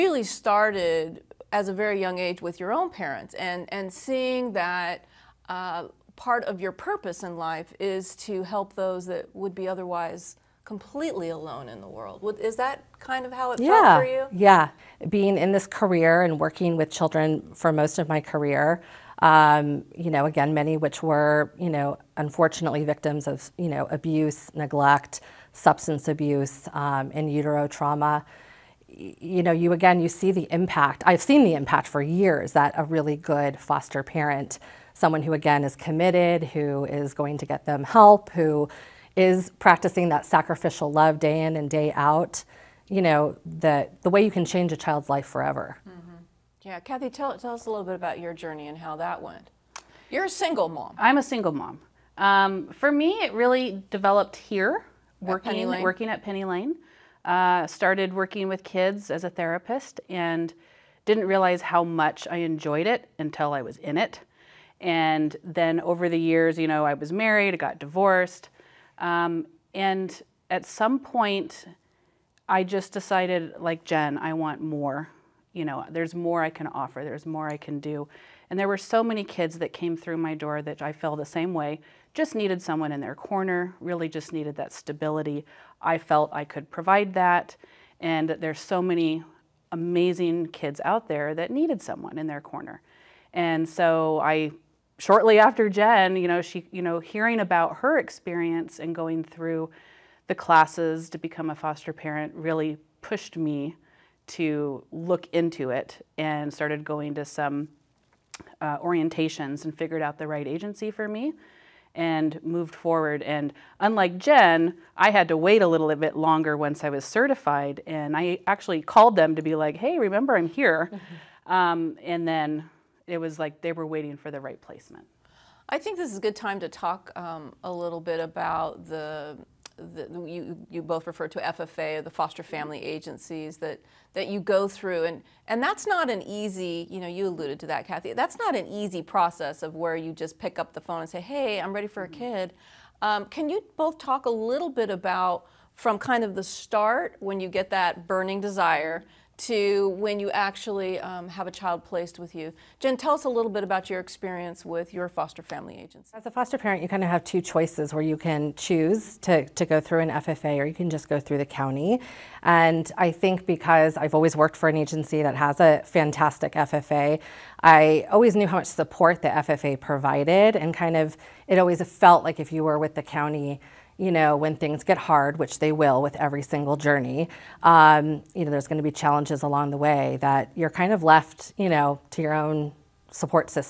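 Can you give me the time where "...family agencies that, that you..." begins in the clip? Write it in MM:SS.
02:12.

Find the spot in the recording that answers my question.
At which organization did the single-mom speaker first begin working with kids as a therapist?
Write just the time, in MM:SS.
00:56.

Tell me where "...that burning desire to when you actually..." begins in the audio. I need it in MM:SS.
02:27.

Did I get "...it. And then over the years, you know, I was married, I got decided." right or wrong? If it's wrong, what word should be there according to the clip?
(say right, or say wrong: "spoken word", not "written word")
wrong: "divorced", not "decided".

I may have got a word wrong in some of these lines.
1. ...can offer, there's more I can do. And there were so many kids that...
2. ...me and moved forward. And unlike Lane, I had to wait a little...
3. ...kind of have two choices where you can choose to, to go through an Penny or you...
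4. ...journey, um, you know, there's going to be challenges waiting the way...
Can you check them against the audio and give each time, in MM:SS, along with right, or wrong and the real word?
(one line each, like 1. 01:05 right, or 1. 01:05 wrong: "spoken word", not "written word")
1. 01:16 right
2. 01:51 wrong: "Jen", not "Lane"
3. 02:36 wrong: "FFA", not "Penny"
4. 02:56 wrong: "along", not "waiting".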